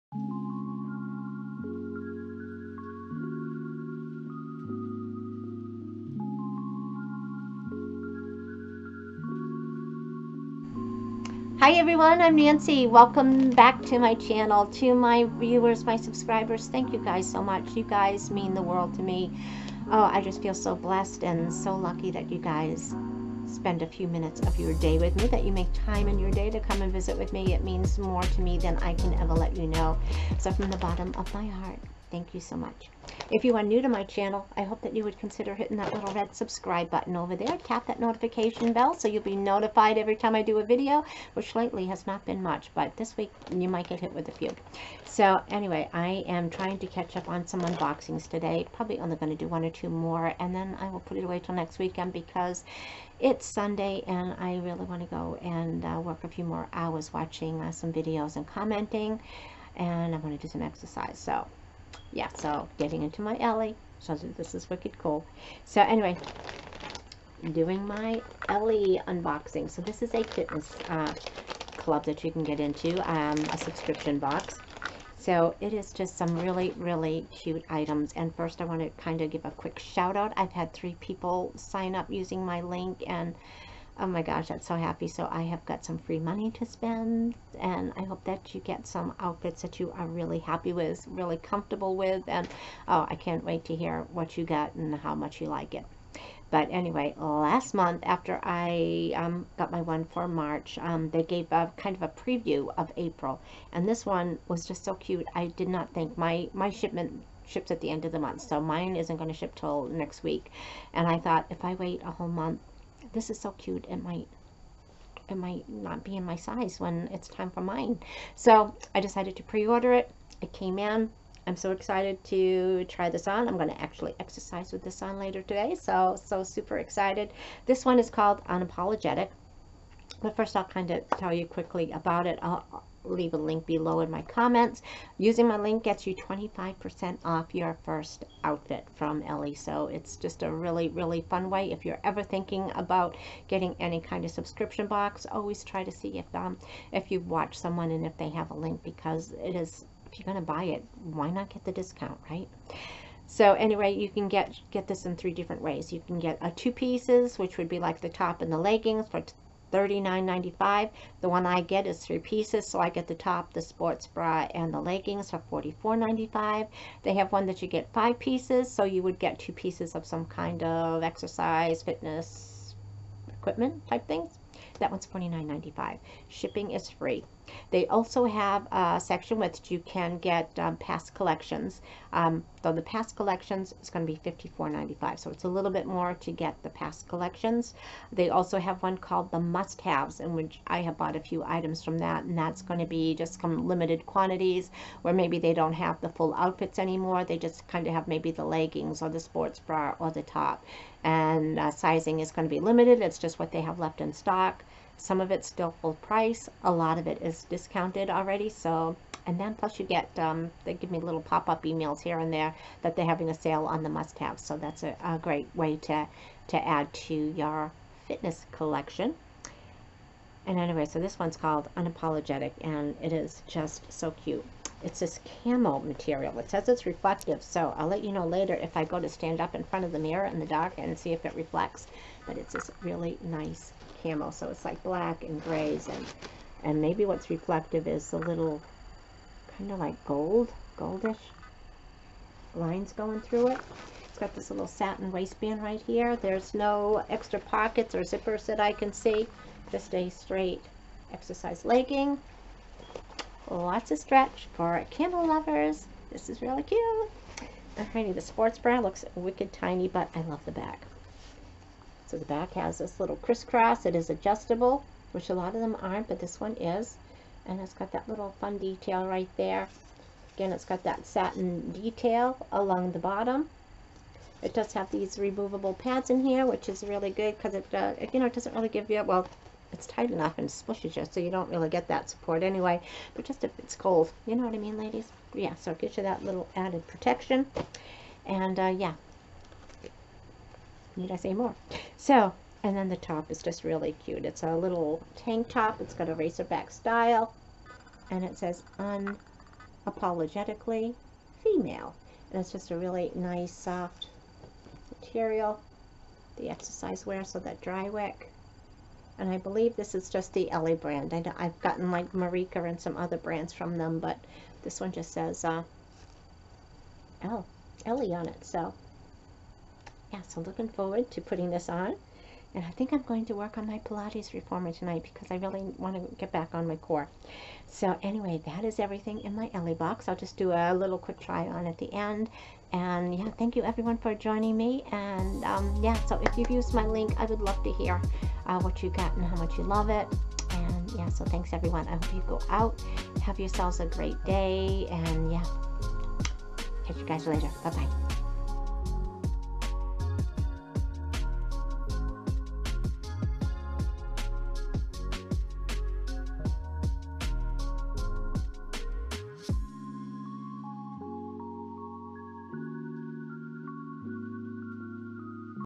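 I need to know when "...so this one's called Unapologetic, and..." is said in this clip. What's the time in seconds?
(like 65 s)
220 s.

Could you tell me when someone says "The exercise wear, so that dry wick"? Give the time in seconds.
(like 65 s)
306 s.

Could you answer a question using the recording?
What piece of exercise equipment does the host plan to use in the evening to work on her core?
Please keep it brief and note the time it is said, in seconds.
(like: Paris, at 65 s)
Pilates reformer, at 323 s.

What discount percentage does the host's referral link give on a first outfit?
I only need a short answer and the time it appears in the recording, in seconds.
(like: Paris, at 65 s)
25%, at 136 s.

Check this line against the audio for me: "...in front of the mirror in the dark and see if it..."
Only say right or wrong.
right.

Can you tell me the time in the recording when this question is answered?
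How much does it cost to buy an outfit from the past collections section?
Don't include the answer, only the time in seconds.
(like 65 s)
184 s.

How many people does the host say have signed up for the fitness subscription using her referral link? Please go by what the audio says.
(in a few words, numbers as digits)
3.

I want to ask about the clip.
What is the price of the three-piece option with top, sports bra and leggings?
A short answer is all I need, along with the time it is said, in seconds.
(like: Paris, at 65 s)
$44.95, at 165 s.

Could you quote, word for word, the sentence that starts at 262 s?
So the back has this little crisscross.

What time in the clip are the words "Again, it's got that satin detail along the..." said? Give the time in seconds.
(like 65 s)
270 s.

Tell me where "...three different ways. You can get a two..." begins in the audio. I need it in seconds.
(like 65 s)
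155 s.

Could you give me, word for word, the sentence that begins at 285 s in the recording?
Yeah, so it gives you that little added protection.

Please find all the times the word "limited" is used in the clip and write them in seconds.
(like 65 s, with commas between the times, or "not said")
193 s, 202 s.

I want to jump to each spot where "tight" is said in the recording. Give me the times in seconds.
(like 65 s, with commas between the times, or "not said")
279 s.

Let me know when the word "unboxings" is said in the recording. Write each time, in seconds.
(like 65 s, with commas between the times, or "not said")
47 s, 69 s.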